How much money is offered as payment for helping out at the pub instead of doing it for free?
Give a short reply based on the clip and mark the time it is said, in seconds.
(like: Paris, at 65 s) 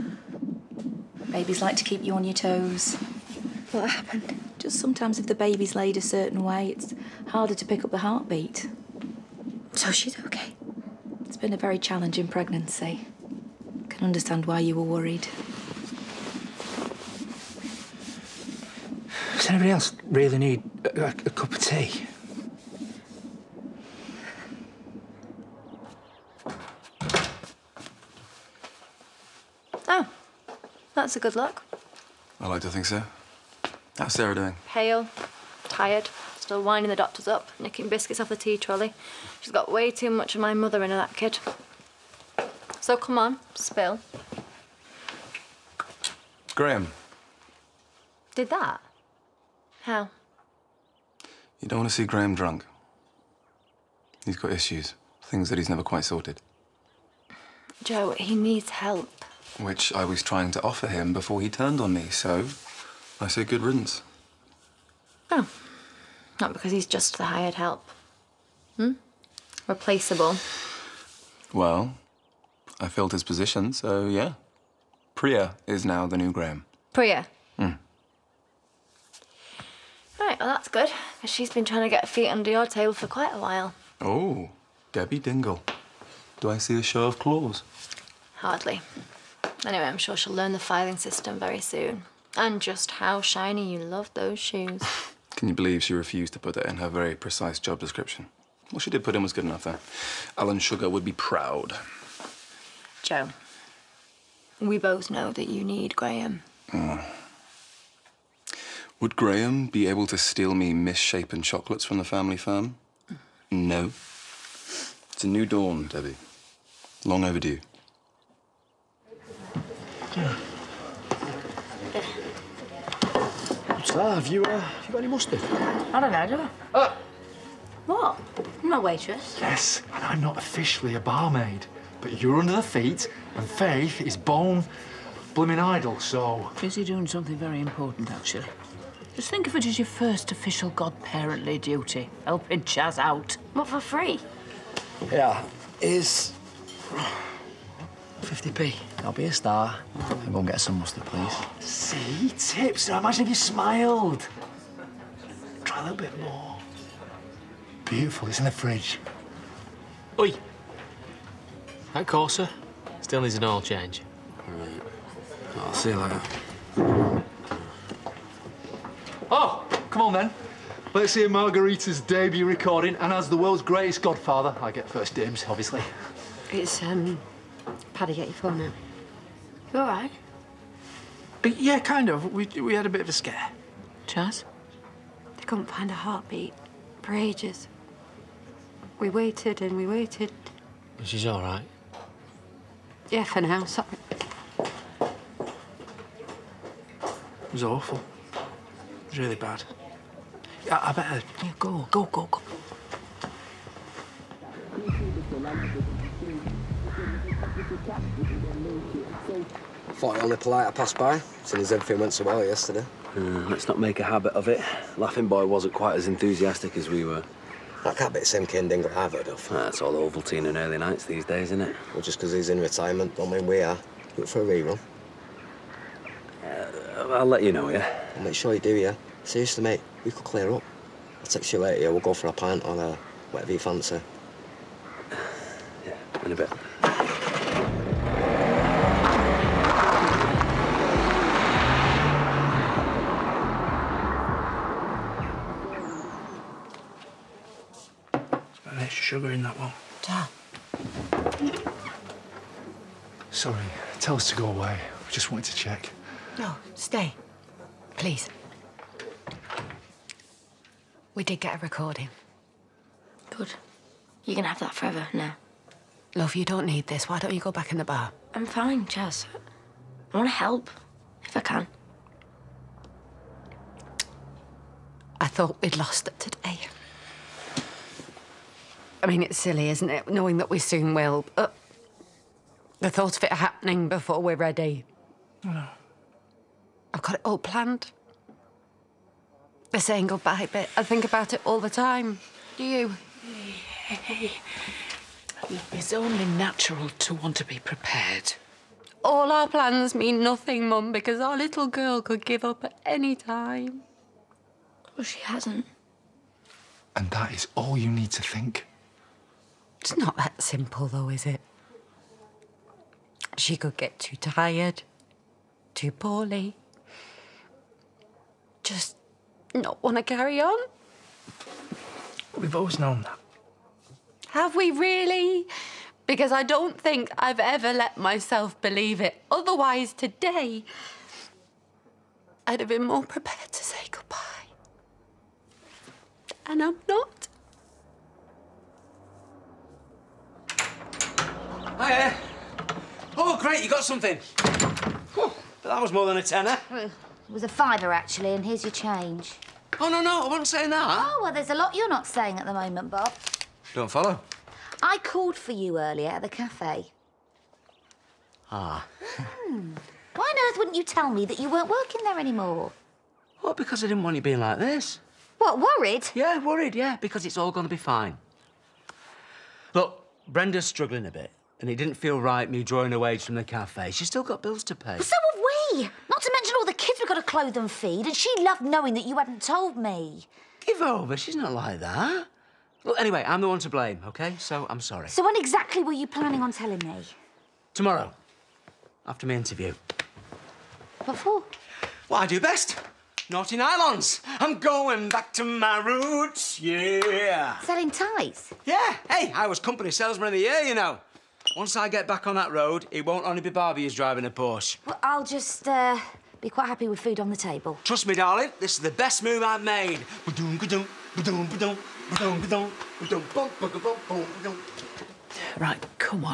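50p, at 148 s.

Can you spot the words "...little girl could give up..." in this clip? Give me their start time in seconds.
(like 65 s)
301 s.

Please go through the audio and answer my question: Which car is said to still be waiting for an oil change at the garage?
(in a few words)
Corsa.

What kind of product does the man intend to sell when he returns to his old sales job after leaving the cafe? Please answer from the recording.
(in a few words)
Naughty nylons.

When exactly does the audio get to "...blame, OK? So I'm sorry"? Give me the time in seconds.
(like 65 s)
383 s.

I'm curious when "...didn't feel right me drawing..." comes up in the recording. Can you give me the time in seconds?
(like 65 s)
371 s.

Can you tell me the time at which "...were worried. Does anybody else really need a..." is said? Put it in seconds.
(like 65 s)
14 s.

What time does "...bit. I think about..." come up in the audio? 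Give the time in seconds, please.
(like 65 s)
290 s.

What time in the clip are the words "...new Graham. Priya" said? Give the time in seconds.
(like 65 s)
76 s.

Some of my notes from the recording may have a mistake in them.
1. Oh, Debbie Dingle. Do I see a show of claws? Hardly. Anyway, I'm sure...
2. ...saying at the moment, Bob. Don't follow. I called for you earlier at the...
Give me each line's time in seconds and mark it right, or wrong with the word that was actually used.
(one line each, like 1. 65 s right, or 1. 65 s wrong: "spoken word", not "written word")
1. 84 s right
2. 352 s right.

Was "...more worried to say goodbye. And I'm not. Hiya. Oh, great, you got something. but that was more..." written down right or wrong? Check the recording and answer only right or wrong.
wrong.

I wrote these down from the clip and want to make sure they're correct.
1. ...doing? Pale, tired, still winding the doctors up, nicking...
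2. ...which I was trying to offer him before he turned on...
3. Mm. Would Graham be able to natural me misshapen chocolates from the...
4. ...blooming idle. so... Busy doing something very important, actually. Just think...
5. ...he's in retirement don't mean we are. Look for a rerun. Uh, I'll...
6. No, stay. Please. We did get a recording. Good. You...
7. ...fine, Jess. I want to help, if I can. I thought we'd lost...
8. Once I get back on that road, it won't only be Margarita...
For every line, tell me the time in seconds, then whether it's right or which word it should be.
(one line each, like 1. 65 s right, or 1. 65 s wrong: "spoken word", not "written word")
1. 34 s right
2. 59 s right
3. 106 s wrong: "steal", not "natural"
4. 135 s right
5. 222 s right
6. 256 s right
7. 268 s right
8. 401 s wrong: "Barbie", not "Margarita".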